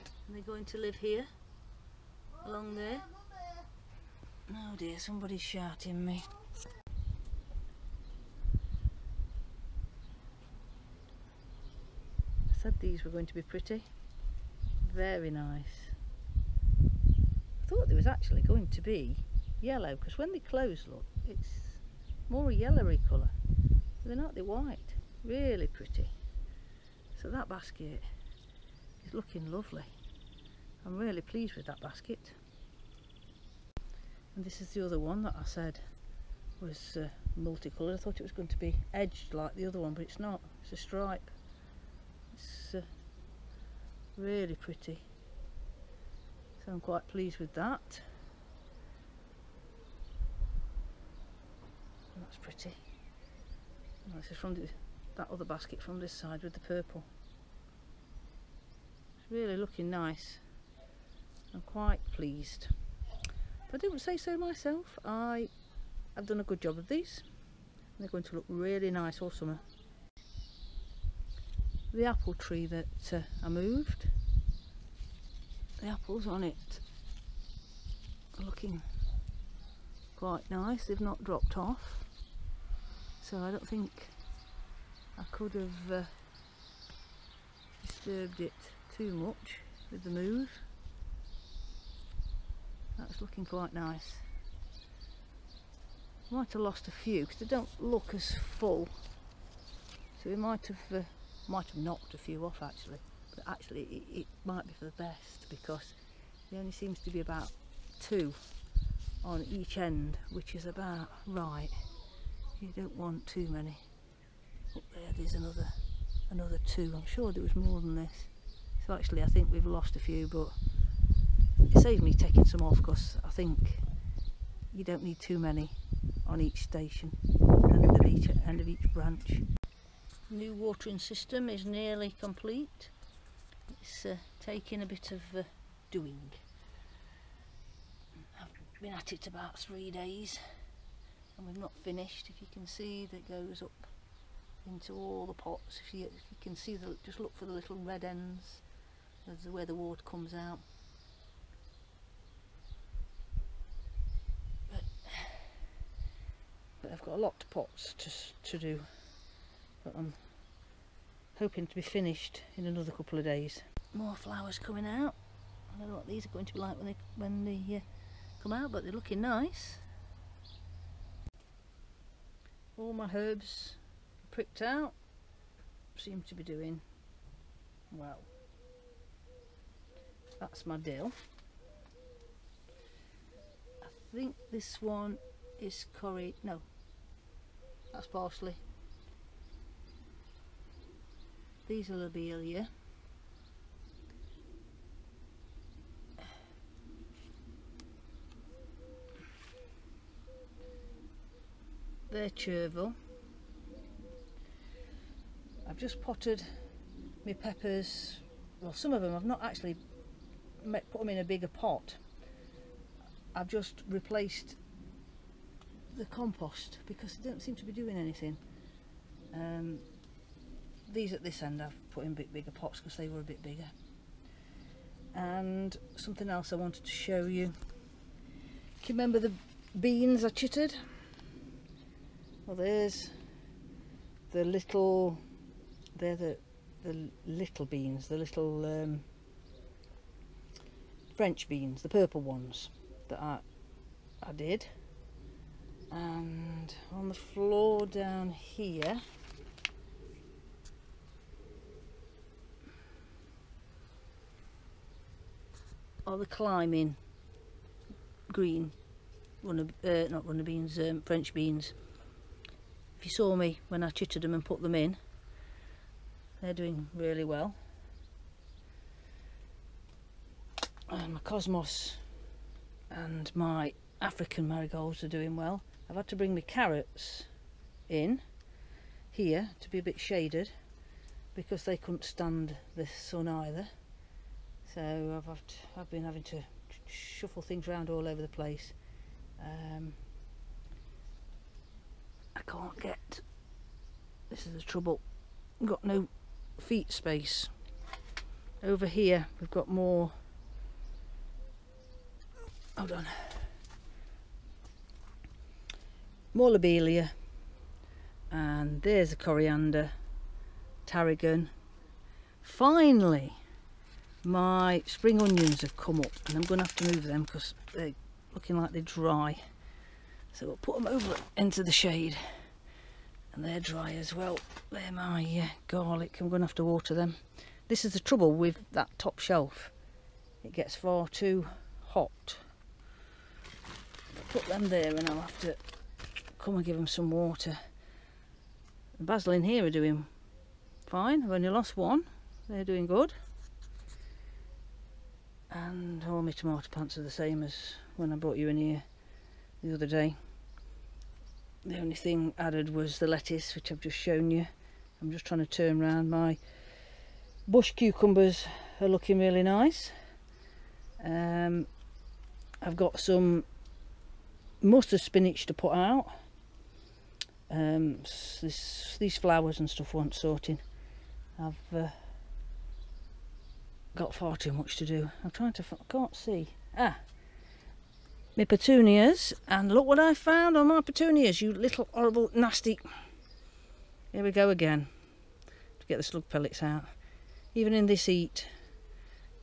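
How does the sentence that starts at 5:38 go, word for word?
The basil in here are doing fine.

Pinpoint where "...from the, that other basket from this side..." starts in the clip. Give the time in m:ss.
0:54.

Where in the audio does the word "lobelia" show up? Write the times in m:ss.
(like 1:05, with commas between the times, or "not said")
3:11, 5:06.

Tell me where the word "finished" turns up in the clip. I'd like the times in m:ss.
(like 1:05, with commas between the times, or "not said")
2:21, 2:41.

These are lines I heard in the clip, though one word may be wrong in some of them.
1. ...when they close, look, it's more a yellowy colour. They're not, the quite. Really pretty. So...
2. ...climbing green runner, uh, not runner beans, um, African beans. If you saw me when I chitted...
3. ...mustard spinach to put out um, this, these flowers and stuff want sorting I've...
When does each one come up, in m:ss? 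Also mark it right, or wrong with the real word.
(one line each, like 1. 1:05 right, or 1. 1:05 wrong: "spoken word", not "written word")
1. 0:20 wrong: "white", not "quite"
2. 4:16 wrong: "French", not "African"
3. 6:04 right.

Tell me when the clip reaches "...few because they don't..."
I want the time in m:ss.
1:36.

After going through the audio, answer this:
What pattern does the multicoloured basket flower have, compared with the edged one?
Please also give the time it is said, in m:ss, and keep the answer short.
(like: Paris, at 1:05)
A stripe, at 0:40.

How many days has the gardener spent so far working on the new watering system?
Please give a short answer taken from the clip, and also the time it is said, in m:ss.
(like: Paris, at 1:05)
About 3 days, at 2:19.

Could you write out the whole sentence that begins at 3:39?
Um, these at this end I've put in a bit bigger pots because they were a bit bigger.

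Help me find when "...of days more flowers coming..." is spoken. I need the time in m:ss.
2:43.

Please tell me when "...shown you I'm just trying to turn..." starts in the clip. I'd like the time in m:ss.
5:53.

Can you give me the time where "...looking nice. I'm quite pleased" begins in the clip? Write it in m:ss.
0:59.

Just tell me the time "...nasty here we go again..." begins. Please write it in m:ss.
6:22.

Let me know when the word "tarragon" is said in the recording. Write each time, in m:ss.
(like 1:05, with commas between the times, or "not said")
5:10.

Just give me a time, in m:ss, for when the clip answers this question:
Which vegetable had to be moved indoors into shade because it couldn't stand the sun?
4:36.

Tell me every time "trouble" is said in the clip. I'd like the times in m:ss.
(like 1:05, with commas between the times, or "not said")
4:54, 5:27.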